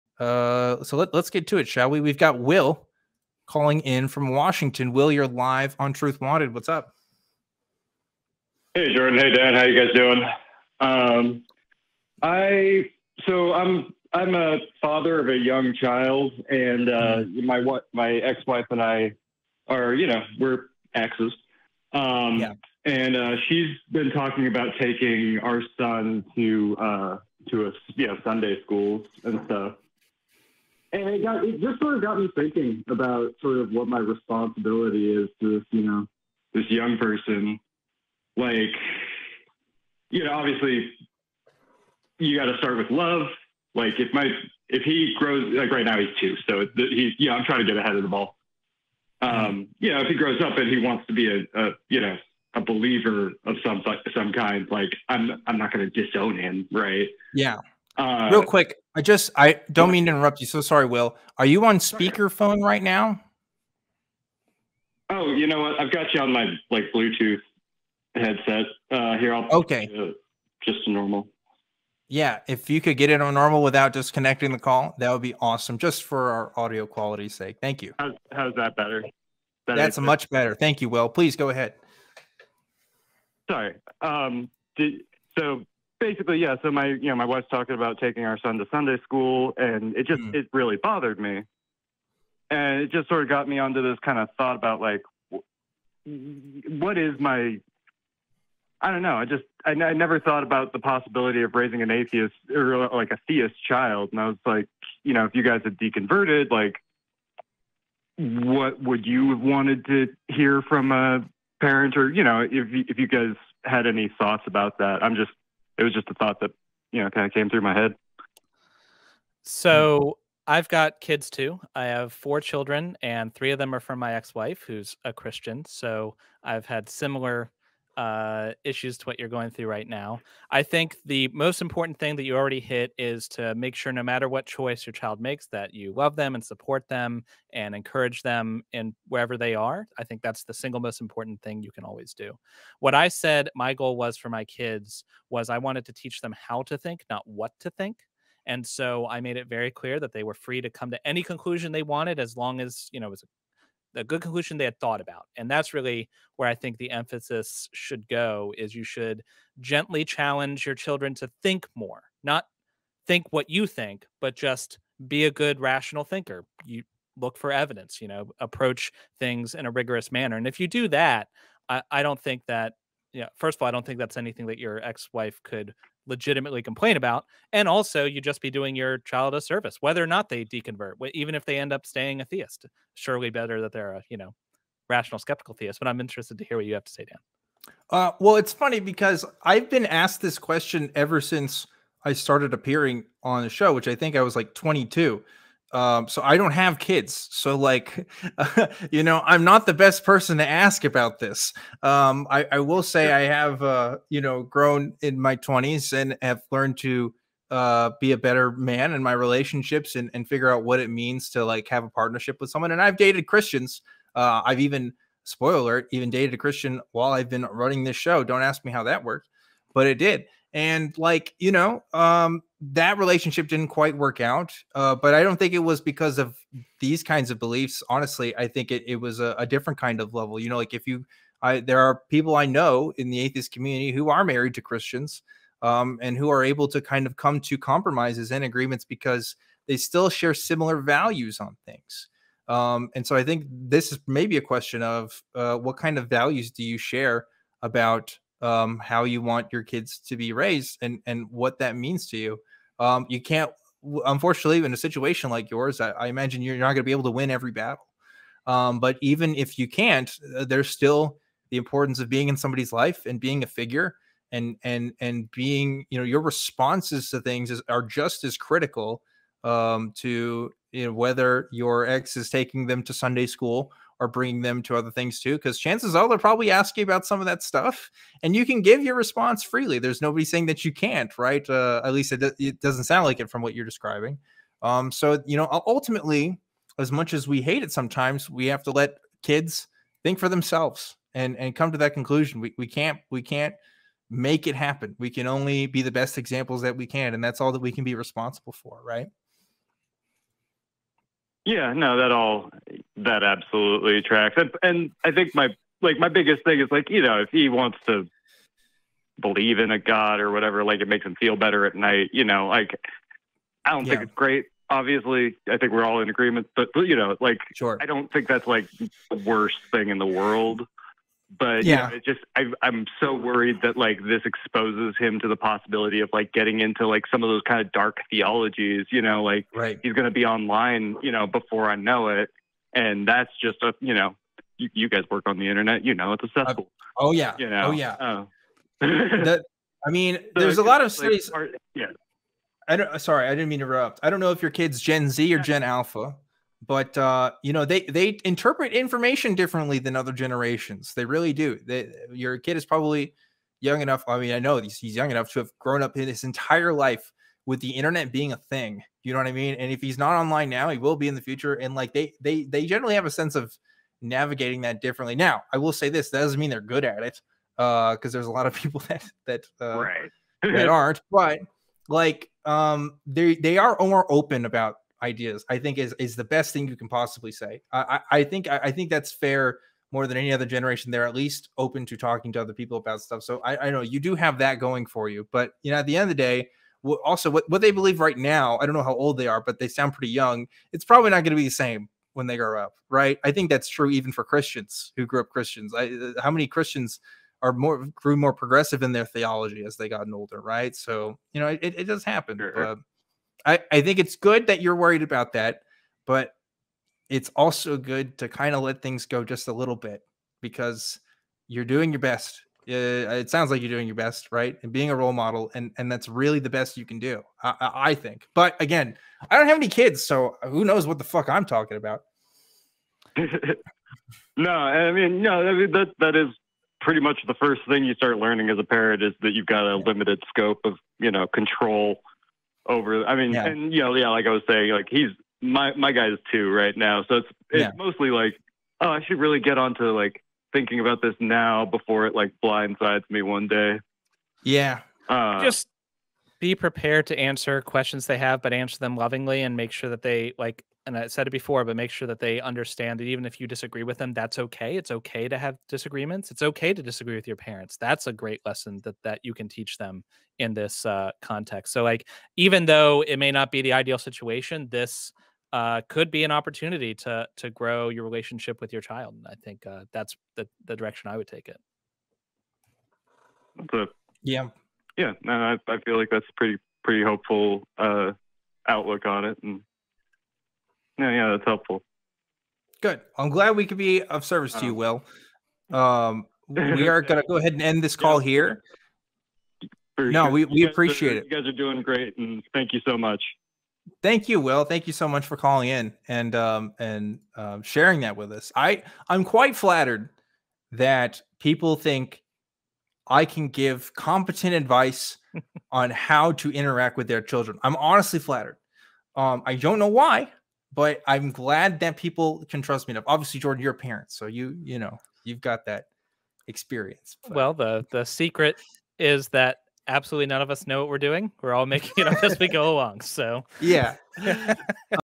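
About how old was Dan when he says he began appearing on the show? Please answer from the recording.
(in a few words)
22.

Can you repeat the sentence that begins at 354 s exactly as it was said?
I mean, I know he's, he's young enough to have grown up in his entire life with the internet being a thing.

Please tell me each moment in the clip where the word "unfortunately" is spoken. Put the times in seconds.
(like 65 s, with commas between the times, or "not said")
254 s.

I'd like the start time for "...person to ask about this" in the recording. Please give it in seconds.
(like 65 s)
200 s.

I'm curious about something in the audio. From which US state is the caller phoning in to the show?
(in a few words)
Washington.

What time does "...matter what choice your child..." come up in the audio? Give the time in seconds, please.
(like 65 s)
134 s.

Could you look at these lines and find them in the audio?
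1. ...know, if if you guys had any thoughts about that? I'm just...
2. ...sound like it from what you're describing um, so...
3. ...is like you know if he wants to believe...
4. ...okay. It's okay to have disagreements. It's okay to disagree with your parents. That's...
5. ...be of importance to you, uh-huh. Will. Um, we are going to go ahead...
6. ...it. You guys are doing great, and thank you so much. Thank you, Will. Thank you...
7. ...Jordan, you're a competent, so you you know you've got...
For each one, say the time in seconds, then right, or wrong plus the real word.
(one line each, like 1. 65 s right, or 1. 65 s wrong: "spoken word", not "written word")
1. 112 s right
2. 282 s right
3. 306 s right
4. 454 s right
5. 483 s wrong: "service", not "importance"
6. 491 s right
7. 513 s wrong: "parent", not "competent".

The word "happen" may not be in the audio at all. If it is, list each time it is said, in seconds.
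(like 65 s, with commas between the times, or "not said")
294 s, 402 s.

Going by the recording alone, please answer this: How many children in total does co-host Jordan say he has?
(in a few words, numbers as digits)
4.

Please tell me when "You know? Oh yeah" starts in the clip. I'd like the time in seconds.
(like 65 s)
337 s.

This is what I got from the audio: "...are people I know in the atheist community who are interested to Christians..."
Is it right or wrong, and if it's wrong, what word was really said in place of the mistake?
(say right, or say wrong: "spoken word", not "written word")
wrong: "married", not "interested".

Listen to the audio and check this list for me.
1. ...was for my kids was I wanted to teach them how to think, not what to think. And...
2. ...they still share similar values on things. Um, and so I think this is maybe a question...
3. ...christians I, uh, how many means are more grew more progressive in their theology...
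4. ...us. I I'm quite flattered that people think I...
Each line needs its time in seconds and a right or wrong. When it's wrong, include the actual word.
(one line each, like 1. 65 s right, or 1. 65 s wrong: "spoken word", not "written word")
1. 143 s right
2. 239 s right
3. 395 s wrong: "christians", not "means"
4. 498 s right.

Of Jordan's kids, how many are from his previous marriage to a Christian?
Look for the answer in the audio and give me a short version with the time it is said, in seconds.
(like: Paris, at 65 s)
3, at 123 s.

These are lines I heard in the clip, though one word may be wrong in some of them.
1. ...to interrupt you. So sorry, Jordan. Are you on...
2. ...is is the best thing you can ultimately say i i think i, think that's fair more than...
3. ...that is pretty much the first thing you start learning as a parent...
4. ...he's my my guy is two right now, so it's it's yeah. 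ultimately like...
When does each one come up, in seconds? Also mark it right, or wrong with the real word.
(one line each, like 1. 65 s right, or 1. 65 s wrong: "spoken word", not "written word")
1. 60 s wrong: "Will", not "Jordan"
2. 375 s wrong: "possibly", not "ultimately"
3. 425 s right
4. 434 s wrong: "mostly", not "ultimately".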